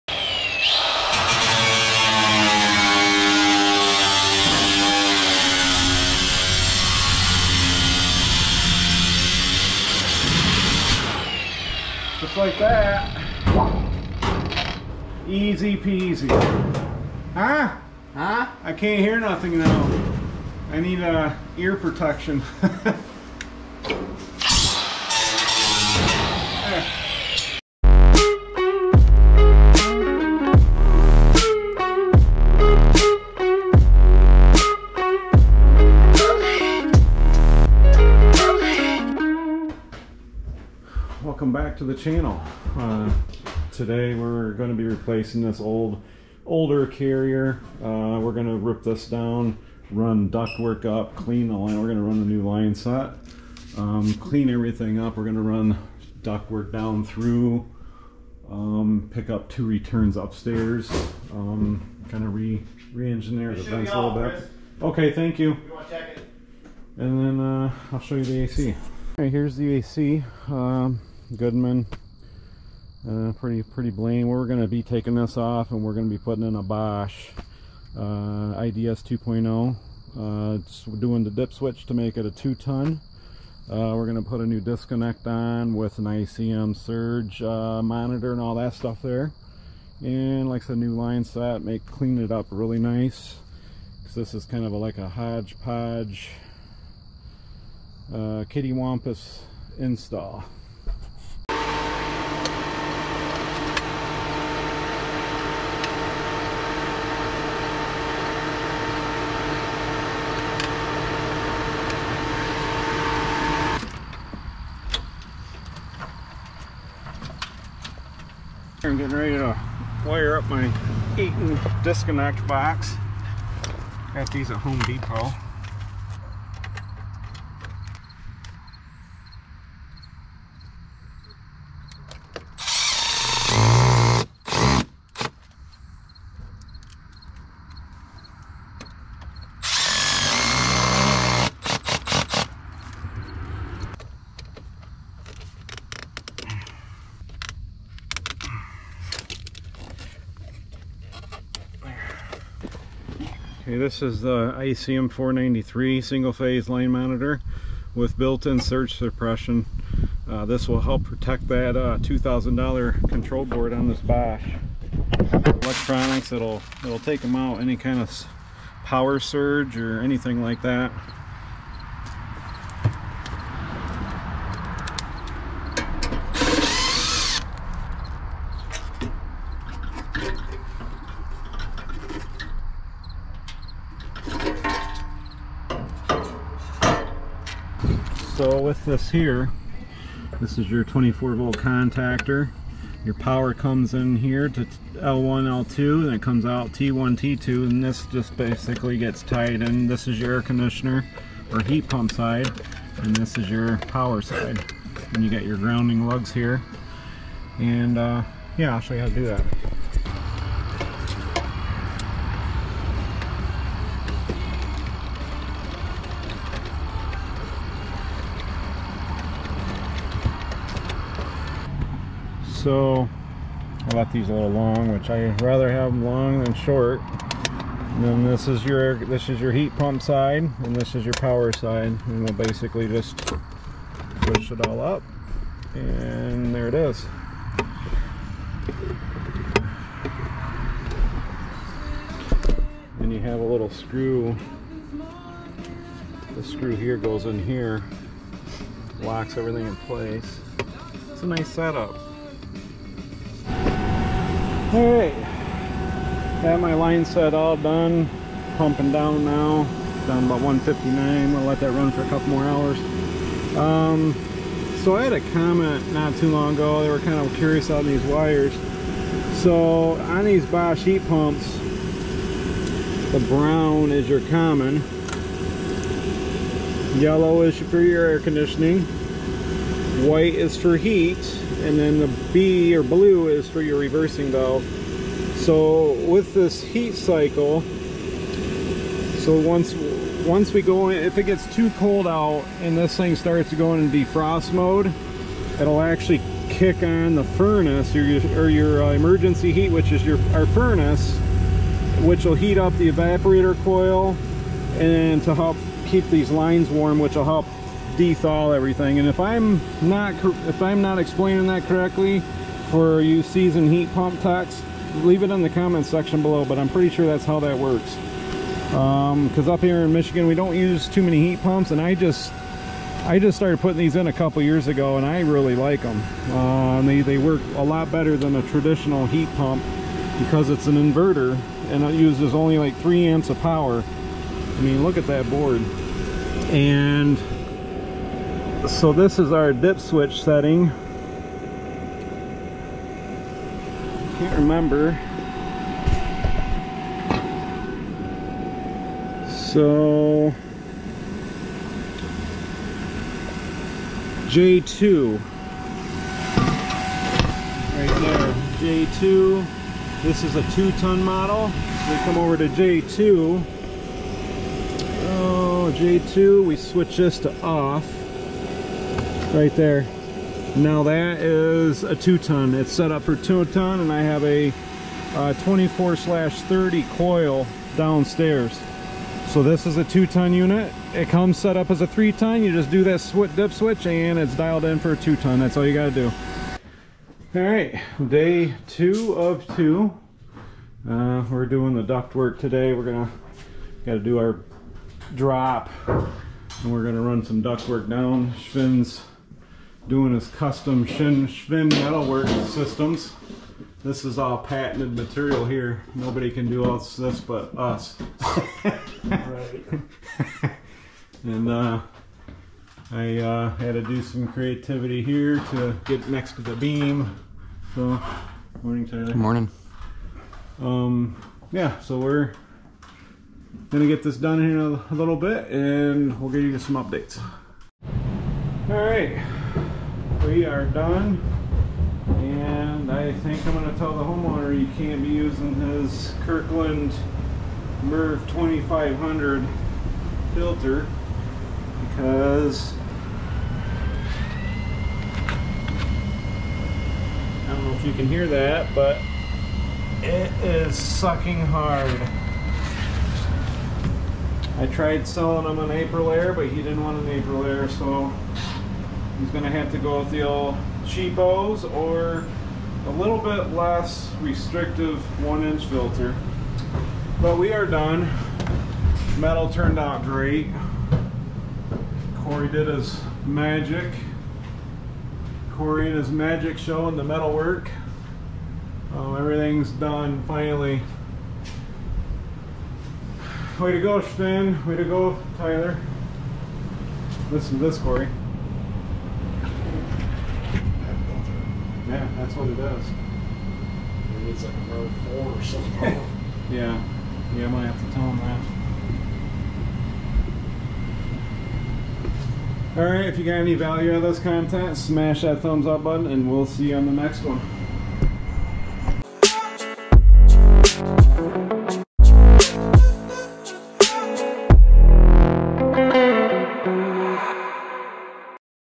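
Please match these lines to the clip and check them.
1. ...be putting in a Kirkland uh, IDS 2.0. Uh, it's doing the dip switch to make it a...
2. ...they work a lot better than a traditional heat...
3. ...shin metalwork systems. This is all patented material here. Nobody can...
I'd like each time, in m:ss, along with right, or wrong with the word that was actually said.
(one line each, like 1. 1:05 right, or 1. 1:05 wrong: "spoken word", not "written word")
1. 1:16 wrong: "Bosch", not "Kirkland"
2. 5:27 right
3. 6:40 right.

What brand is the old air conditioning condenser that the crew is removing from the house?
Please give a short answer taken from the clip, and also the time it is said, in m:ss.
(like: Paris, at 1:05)
Goodman, at 1:11.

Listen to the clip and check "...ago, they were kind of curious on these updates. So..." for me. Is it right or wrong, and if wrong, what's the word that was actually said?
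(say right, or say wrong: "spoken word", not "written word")
wrong: "wires", not "updates".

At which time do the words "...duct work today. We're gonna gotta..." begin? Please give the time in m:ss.
6:31.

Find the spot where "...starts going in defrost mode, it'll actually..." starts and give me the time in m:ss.
4:53.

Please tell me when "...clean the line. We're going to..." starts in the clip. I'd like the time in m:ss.
0:51.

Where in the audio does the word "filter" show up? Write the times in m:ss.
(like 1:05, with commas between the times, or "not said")
7:20, 7:45.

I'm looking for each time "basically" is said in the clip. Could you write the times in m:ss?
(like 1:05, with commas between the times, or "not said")
3:18, 3:52.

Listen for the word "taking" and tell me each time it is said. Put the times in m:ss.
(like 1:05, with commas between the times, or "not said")
1:14.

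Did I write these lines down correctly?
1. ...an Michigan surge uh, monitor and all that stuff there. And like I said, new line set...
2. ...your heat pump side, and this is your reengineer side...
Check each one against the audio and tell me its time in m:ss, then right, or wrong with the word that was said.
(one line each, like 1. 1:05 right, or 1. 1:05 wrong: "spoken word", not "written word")
1. 1:25 wrong: "ICM", not "Michigan"
2. 3:49 wrong: "power", not "reengineer".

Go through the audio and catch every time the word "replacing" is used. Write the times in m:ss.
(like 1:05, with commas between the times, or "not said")
0:44.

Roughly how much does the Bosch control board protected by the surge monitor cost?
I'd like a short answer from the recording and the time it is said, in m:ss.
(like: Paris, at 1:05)
$2,000, at 2:41.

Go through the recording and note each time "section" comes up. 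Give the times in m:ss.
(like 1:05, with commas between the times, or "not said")
5:15.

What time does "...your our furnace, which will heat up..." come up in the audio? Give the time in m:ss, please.
5:00.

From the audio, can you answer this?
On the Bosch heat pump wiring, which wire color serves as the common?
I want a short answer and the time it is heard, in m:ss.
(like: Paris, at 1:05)
Brown, at 4:33.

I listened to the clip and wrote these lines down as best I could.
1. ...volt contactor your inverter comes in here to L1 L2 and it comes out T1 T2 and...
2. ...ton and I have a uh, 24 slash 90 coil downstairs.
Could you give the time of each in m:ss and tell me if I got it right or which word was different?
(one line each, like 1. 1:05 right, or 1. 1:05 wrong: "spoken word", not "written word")
1. 3:11 wrong: "power", not "inverter"
2. 6:13 wrong: "30", not "90".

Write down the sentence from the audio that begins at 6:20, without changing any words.
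It comes set up as a three ton.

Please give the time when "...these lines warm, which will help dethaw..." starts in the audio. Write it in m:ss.
5:06.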